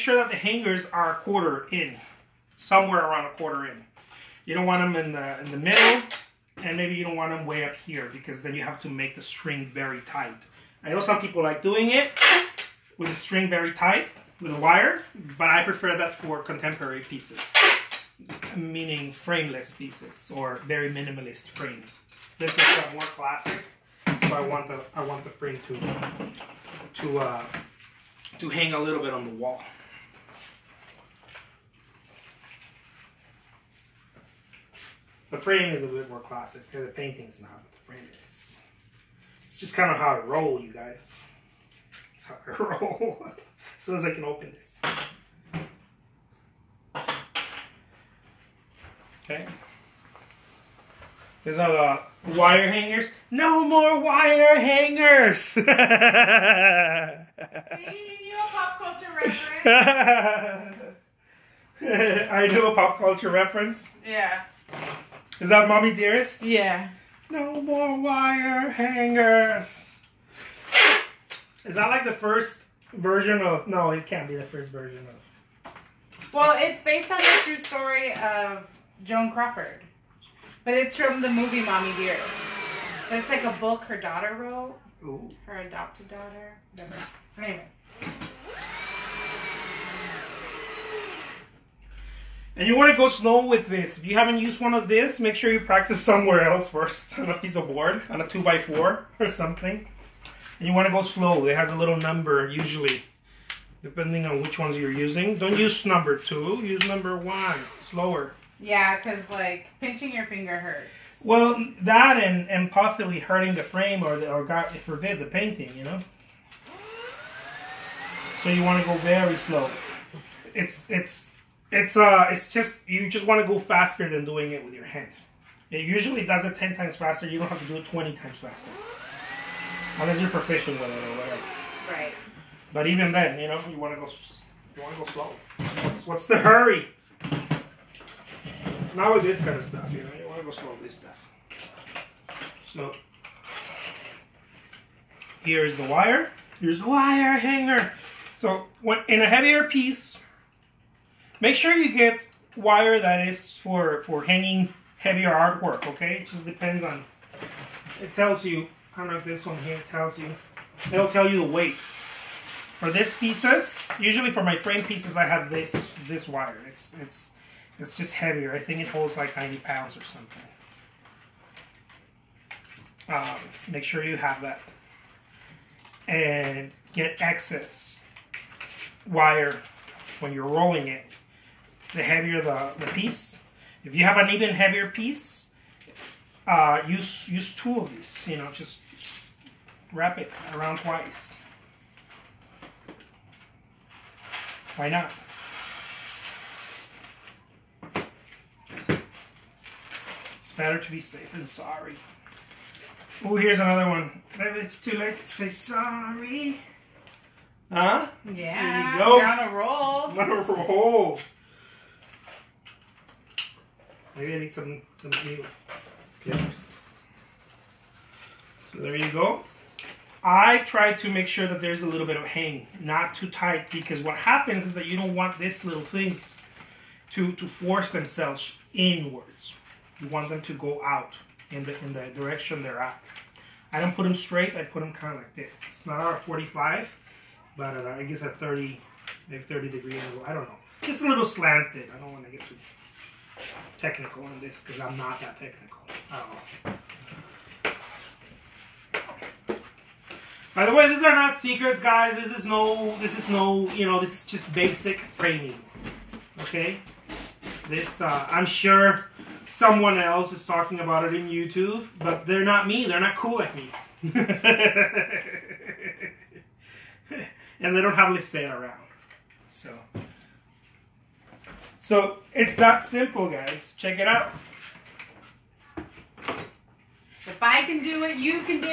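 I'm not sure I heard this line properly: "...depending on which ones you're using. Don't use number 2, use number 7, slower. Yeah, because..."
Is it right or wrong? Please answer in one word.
wrong.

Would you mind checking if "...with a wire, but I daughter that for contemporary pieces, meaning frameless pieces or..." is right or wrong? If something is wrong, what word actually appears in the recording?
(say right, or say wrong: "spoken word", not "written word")
wrong: "prefer", not "daughter".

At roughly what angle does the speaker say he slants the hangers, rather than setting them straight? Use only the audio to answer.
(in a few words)
30 degrees.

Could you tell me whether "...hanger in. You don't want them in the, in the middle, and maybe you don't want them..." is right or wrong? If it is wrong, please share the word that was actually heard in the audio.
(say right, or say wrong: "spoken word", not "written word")
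wrong: "quarter", not "hanger".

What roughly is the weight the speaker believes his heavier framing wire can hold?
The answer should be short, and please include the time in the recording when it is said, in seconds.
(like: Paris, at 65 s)
90 pounds, at 169 s.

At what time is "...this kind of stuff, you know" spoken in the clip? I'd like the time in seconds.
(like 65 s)
139 s.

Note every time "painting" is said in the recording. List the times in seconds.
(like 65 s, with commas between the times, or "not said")
36 s, 115 s.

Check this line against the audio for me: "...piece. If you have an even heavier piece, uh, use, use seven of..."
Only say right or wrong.
wrong.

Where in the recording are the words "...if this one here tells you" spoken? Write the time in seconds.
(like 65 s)
159 s.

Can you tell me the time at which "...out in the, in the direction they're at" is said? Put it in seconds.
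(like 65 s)
230 s.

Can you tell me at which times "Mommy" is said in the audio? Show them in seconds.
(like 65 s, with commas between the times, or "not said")
65 s, 81 s.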